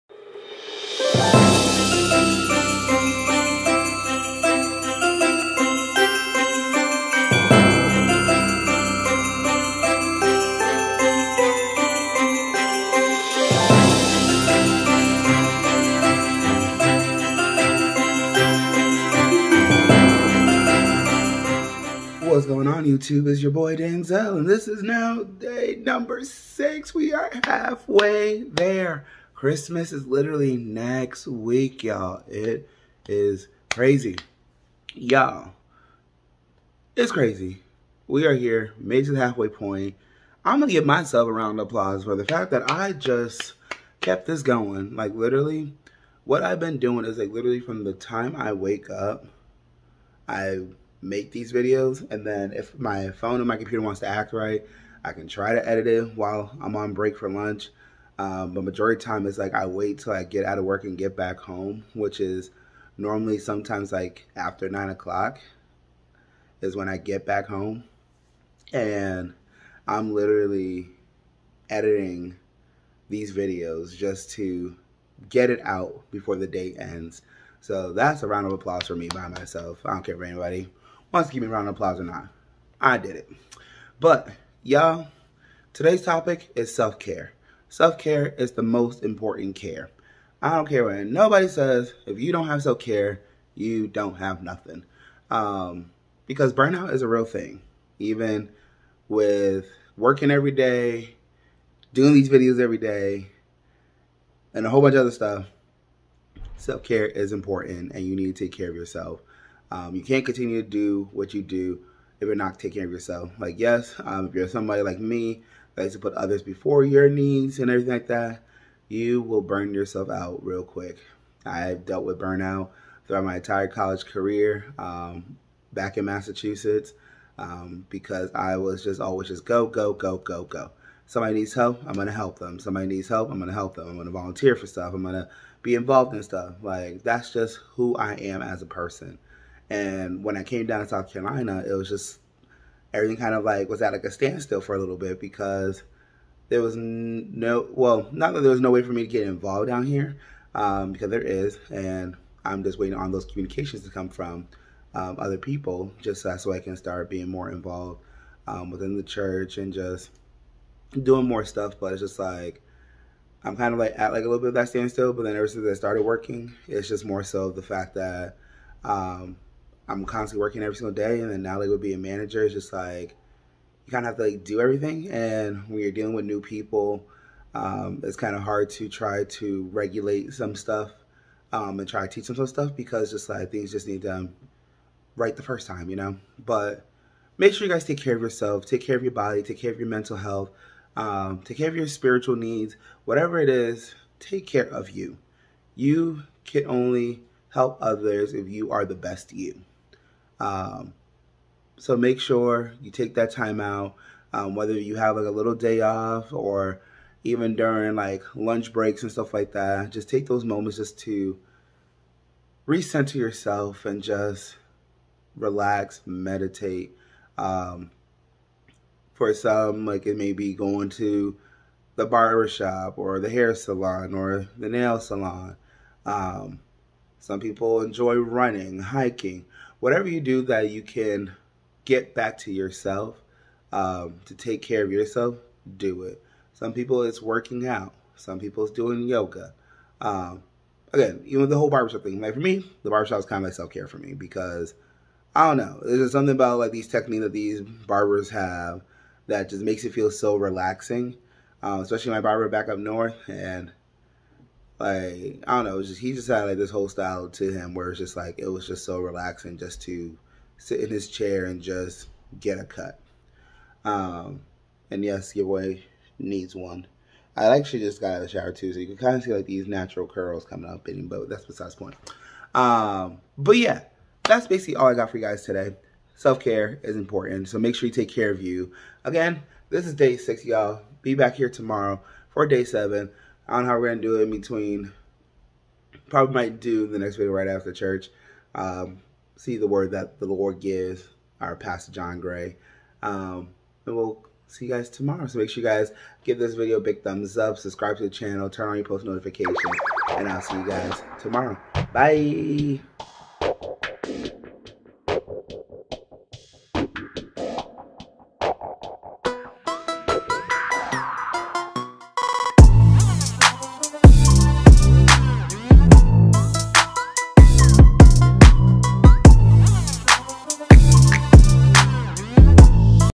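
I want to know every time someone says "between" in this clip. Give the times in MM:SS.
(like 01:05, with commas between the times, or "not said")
04:44.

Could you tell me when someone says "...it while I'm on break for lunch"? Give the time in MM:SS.
00:55.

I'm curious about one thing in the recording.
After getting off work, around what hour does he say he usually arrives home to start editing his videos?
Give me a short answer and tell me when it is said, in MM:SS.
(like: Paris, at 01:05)
9 o'clock, at 01:04.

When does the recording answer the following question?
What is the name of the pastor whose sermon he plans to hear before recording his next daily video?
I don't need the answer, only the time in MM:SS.
04:51.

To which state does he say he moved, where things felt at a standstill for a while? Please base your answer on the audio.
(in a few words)
South Carolina.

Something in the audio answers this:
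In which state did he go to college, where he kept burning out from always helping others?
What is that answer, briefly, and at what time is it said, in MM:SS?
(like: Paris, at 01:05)
Massachusetts, at 02:06.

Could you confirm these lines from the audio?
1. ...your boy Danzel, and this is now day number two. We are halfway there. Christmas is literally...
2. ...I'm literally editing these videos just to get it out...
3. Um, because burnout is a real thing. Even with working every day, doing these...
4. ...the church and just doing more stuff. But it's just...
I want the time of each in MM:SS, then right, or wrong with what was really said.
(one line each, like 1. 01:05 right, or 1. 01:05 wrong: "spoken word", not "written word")
1. 00:23 wrong: "six", not "two"
2. 01:09 right
3. 01:35 right
4. 02:38 right.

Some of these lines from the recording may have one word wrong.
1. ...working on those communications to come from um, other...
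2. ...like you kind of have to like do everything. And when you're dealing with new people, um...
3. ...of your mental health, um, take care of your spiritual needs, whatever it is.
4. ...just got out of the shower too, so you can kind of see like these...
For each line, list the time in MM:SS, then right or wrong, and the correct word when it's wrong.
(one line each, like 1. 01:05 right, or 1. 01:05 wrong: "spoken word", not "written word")
1. 02:32 wrong: "waiting", not "working"
2. 02:52 right
3. 03:09 right
4. 04:27 right.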